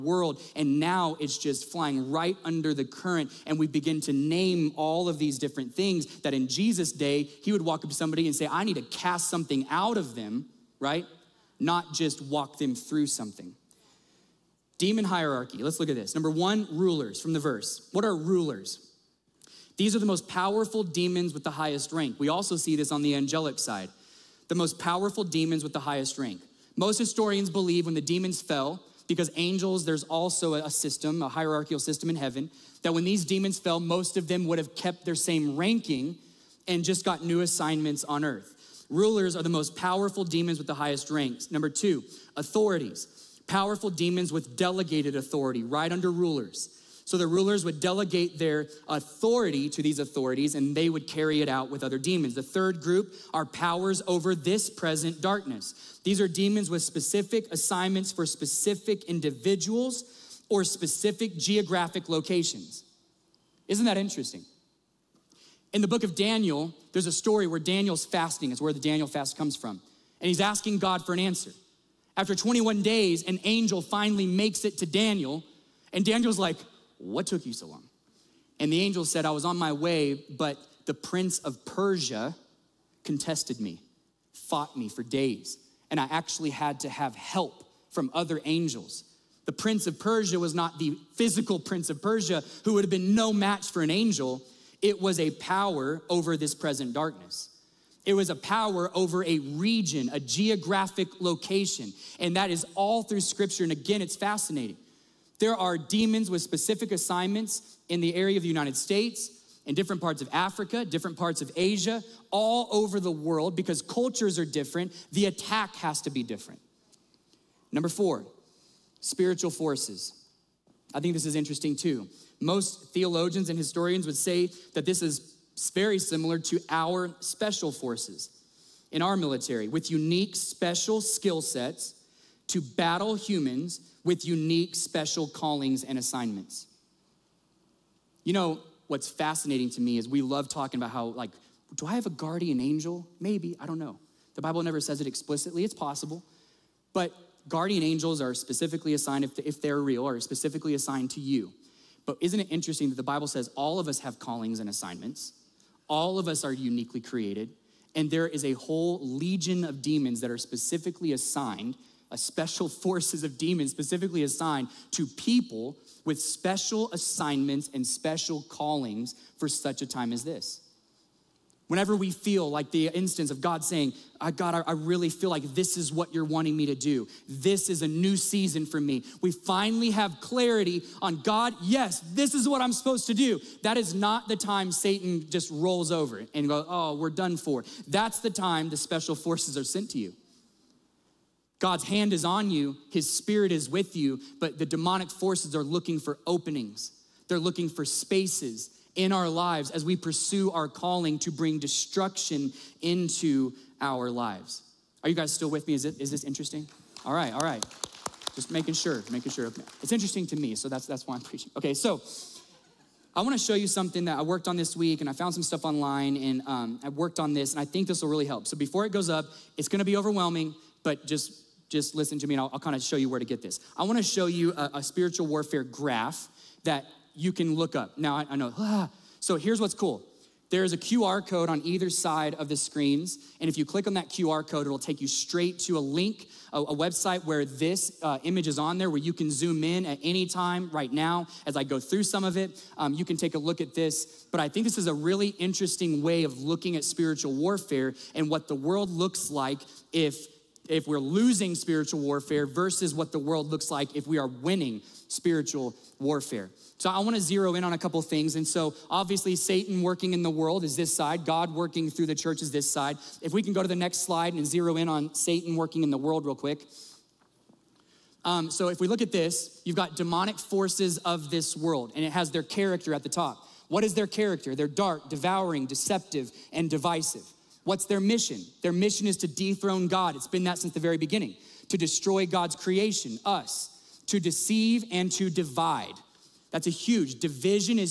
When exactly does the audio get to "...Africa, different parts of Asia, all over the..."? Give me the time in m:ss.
1:50.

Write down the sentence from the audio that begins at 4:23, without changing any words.
If we can go to the next slide and zero in on Satan working in the world real quick.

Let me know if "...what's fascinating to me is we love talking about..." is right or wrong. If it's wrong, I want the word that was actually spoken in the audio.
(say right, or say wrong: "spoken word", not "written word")
right.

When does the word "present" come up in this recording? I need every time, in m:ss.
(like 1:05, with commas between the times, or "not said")
0:54, 1:36.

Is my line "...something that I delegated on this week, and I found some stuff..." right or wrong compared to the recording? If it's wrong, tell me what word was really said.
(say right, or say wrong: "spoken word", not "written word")
wrong: "worked", not "delegated".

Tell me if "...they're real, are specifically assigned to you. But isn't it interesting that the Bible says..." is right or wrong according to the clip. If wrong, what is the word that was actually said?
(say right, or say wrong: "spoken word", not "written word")
right.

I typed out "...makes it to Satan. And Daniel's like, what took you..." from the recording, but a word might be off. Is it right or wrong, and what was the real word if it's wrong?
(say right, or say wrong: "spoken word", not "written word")
wrong: "Daniel", not "Satan".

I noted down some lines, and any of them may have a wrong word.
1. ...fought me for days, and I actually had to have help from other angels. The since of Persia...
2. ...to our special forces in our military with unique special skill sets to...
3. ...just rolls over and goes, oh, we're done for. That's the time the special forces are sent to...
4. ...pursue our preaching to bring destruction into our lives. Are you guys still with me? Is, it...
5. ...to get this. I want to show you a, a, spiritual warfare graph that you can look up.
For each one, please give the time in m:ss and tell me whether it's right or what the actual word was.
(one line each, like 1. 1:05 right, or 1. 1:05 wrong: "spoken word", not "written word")
1. 1:24 wrong: "prince", not "since"
2. 2:06 right
3. 3:05 right
4. 3:19 wrong: "calling", not "preaching"
5. 3:43 right.